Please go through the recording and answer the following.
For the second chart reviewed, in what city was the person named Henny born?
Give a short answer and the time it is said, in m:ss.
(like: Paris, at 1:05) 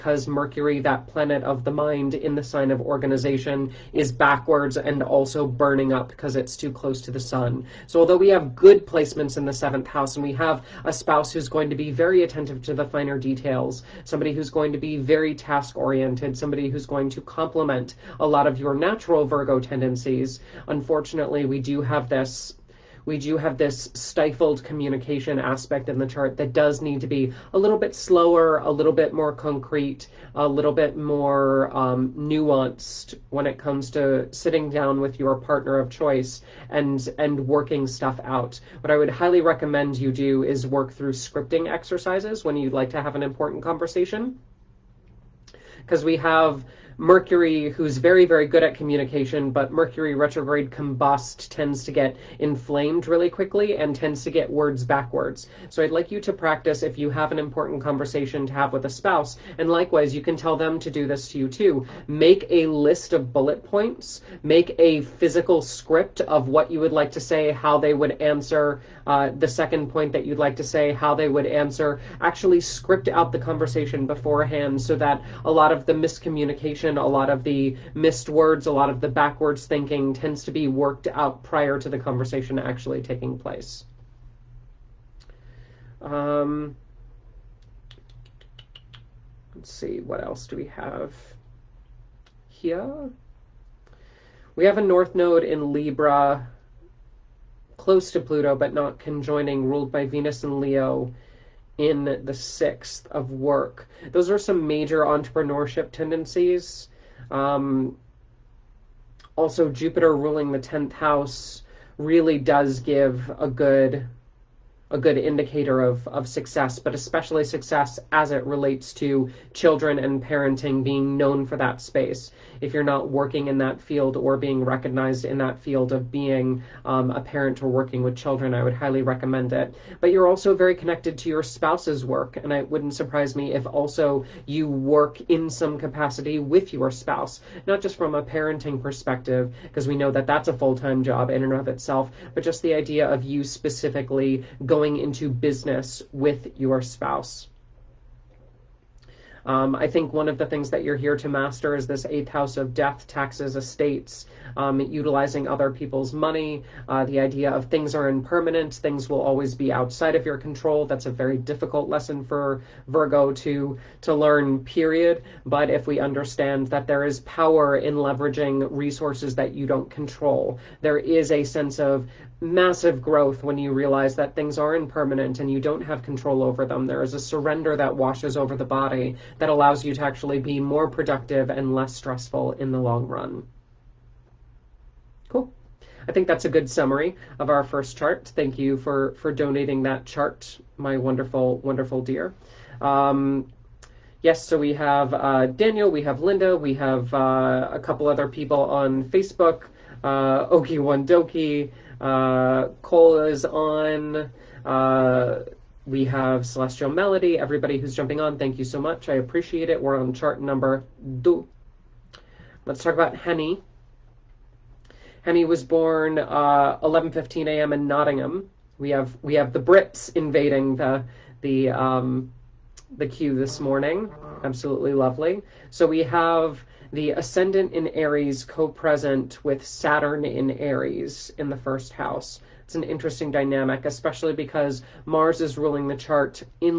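Nottingham, at 3:37.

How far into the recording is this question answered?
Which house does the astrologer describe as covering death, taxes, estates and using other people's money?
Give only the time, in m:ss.
2:32.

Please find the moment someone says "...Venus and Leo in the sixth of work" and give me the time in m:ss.
1:40.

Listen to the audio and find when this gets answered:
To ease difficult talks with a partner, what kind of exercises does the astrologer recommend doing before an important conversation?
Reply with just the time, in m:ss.
0:41.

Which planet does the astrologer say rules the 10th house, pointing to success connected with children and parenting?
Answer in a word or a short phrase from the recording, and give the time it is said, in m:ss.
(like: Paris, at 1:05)
Jupiter, at 1:49.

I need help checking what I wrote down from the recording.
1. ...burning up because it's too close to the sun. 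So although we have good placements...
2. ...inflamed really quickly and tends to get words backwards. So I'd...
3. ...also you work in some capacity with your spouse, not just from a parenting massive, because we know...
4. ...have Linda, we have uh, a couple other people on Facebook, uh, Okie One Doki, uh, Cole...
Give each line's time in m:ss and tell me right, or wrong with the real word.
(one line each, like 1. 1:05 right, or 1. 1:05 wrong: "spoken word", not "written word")
1. 0:05 right
2. 0:52 right
3. 2:13 wrong: "perspective", not "massive"
4. 3:16 right.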